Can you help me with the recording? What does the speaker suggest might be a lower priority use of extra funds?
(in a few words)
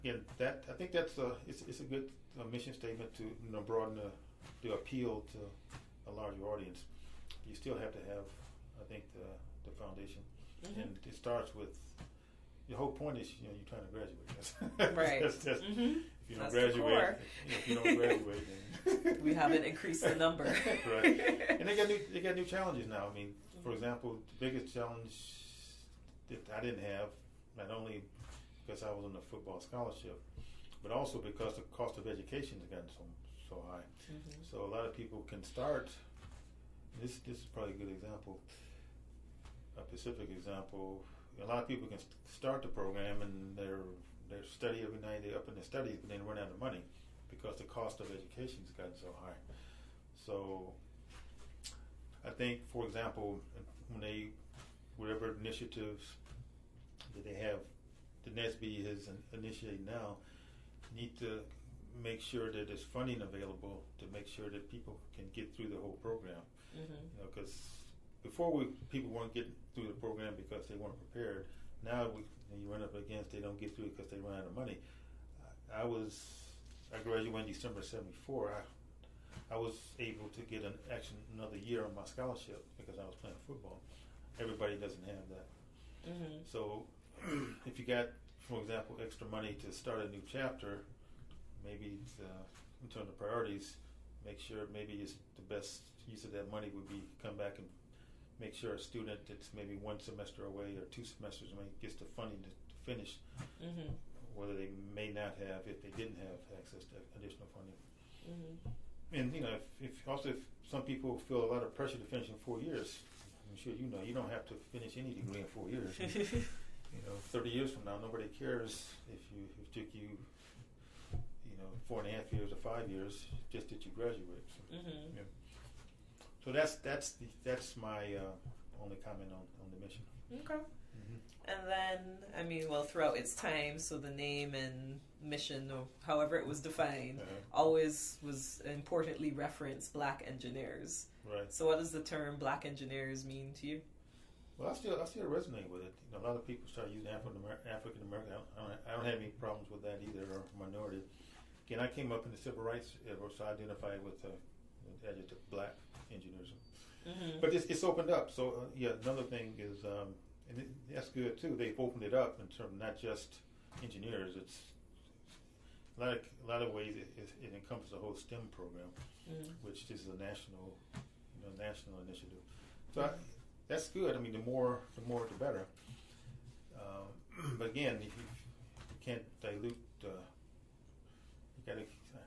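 A new chapter.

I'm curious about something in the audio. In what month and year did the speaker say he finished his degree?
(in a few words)
December 1974.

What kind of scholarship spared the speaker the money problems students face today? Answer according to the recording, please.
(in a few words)
Football scholarship.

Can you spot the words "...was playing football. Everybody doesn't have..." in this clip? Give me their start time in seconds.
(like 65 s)
83 s.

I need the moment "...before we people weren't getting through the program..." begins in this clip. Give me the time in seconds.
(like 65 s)
68 s.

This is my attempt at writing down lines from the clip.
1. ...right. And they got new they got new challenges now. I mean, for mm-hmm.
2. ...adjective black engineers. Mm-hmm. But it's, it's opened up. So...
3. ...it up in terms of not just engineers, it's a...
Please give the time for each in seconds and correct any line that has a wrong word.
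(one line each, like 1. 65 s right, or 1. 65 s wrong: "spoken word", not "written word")
1. 20 s right
2. 155 s right
3. 162 s right.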